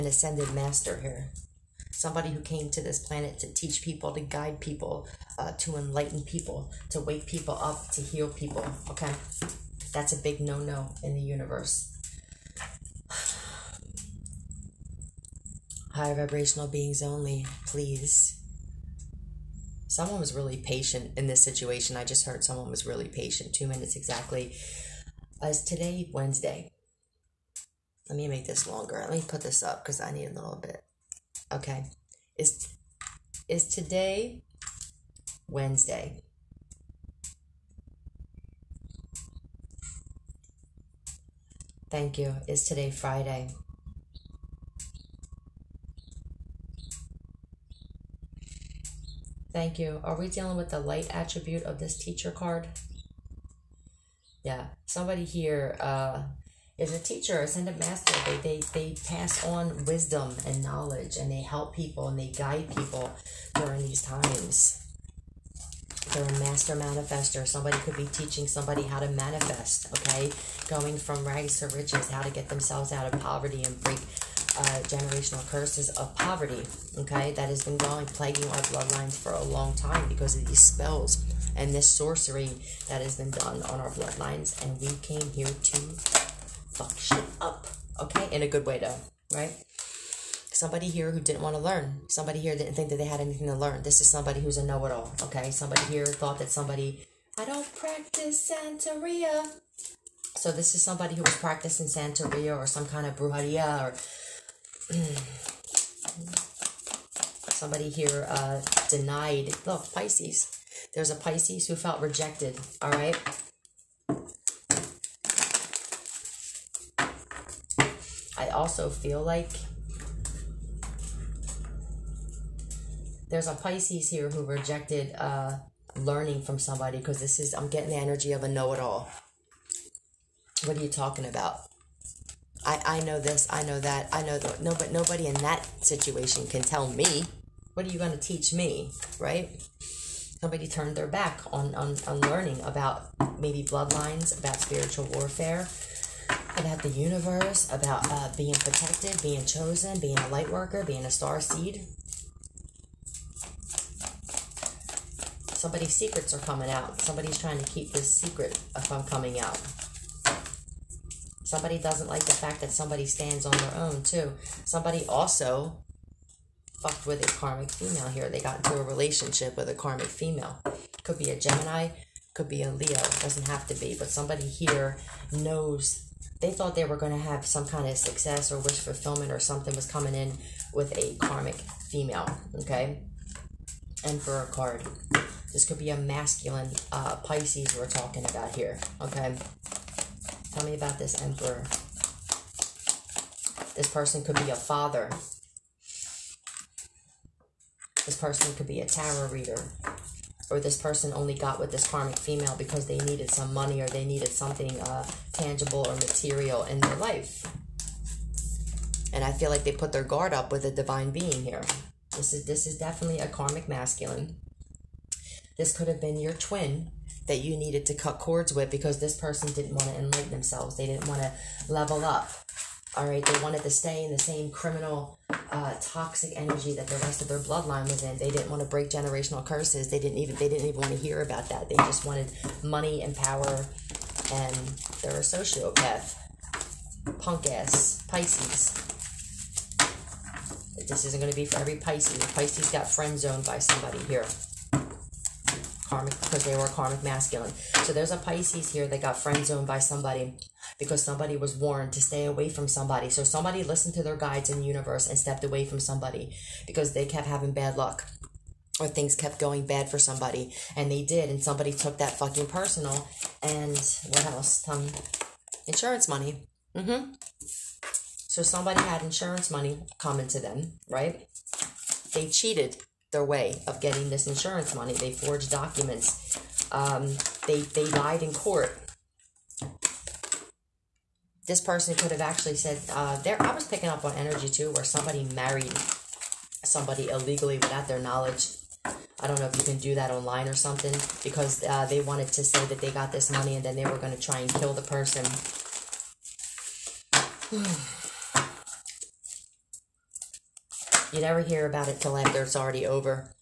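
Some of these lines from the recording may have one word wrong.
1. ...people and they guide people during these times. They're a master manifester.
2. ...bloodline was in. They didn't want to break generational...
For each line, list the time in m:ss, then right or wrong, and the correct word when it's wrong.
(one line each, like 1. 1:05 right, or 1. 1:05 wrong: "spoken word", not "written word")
1. 1:01 right
2. 3:47 right.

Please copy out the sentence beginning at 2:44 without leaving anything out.
Somebody also fucked with a karmic female here.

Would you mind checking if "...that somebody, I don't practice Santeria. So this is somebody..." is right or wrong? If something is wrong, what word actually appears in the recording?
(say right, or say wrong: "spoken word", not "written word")
right.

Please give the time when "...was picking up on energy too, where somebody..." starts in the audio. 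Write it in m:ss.
4:43.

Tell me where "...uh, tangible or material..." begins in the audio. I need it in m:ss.
3:24.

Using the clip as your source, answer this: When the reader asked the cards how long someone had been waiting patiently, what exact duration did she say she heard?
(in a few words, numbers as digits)
Two minutes.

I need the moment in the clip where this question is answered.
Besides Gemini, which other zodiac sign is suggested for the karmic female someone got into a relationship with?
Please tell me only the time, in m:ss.
2:52.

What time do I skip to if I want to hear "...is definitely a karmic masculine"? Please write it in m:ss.
3:32.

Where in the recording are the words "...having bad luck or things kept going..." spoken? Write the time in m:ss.
4:17.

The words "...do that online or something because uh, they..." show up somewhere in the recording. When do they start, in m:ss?
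4:49.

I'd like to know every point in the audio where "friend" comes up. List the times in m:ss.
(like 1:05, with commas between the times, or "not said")
4:02, 4:09.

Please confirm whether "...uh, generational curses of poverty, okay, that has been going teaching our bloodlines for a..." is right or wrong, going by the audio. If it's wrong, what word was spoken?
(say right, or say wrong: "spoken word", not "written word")
wrong: "plaguing", not "teaching".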